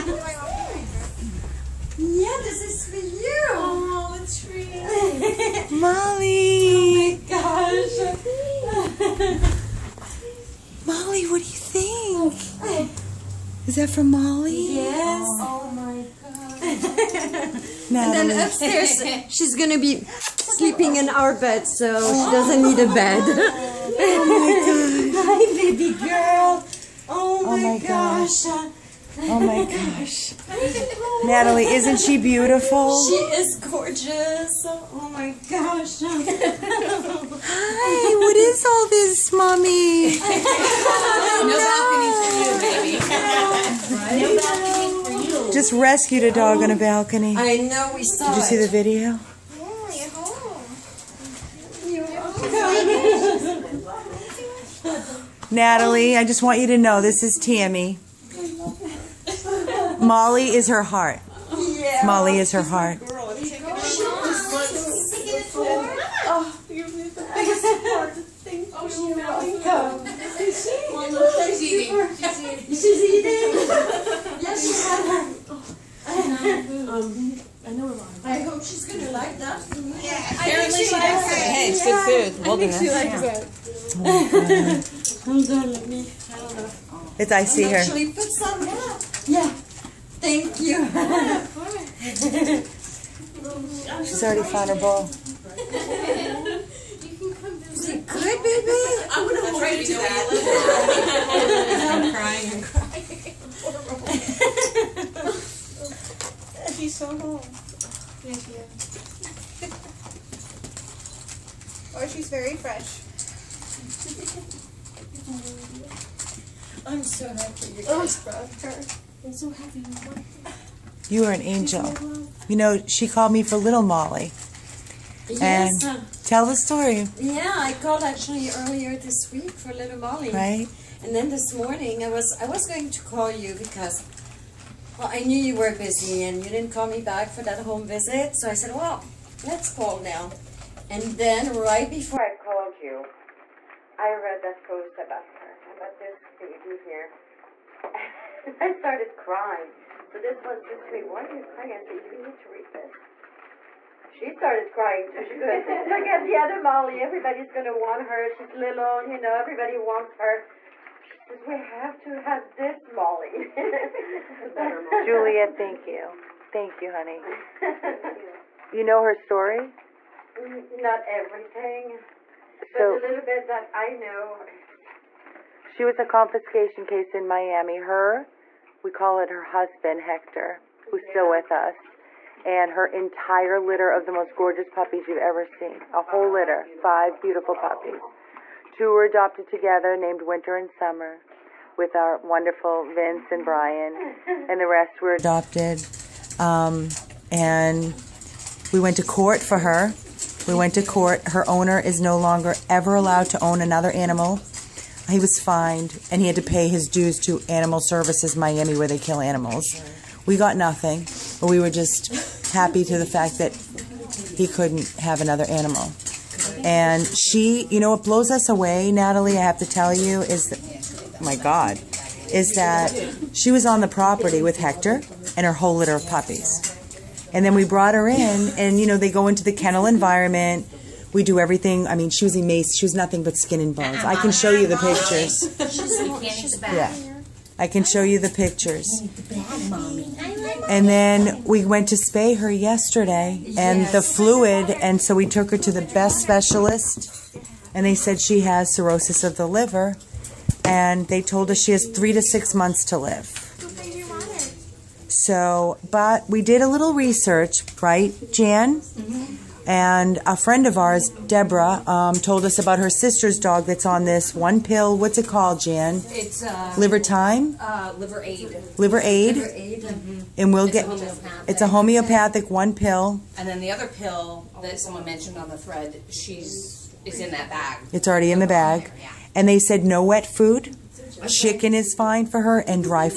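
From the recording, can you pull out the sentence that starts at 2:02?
You know, she called me for Little Molly.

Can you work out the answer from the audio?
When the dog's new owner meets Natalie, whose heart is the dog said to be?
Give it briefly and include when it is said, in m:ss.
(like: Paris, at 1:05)
Tammy, at 0:57.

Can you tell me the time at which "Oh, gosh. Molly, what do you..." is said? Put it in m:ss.
0:06.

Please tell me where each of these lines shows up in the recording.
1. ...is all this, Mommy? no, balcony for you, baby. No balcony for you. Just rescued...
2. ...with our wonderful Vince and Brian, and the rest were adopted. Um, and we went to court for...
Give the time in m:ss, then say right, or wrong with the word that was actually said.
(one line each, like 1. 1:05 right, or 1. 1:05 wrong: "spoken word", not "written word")
1. 0:38 right
2. 3:11 right.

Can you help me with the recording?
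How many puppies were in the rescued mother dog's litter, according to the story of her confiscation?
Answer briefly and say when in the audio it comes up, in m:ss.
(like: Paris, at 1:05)
5, at 3:06.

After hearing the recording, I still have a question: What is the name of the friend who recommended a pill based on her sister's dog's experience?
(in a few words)
Deborah.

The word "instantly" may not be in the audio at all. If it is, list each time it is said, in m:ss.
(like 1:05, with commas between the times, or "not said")
not said.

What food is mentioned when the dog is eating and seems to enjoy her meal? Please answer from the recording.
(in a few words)
Wilderness.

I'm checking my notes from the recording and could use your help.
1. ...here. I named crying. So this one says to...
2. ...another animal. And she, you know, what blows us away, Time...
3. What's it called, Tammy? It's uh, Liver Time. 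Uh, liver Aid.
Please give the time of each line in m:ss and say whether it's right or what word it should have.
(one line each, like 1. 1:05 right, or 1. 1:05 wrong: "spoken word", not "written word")
1. 2:26 wrong: "started", not "named"
2. 3:35 wrong: "Natalie", not "Time"
3. 4:24 wrong: "Jan", not "Tammy".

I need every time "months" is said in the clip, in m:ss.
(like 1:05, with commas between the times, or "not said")
4:12.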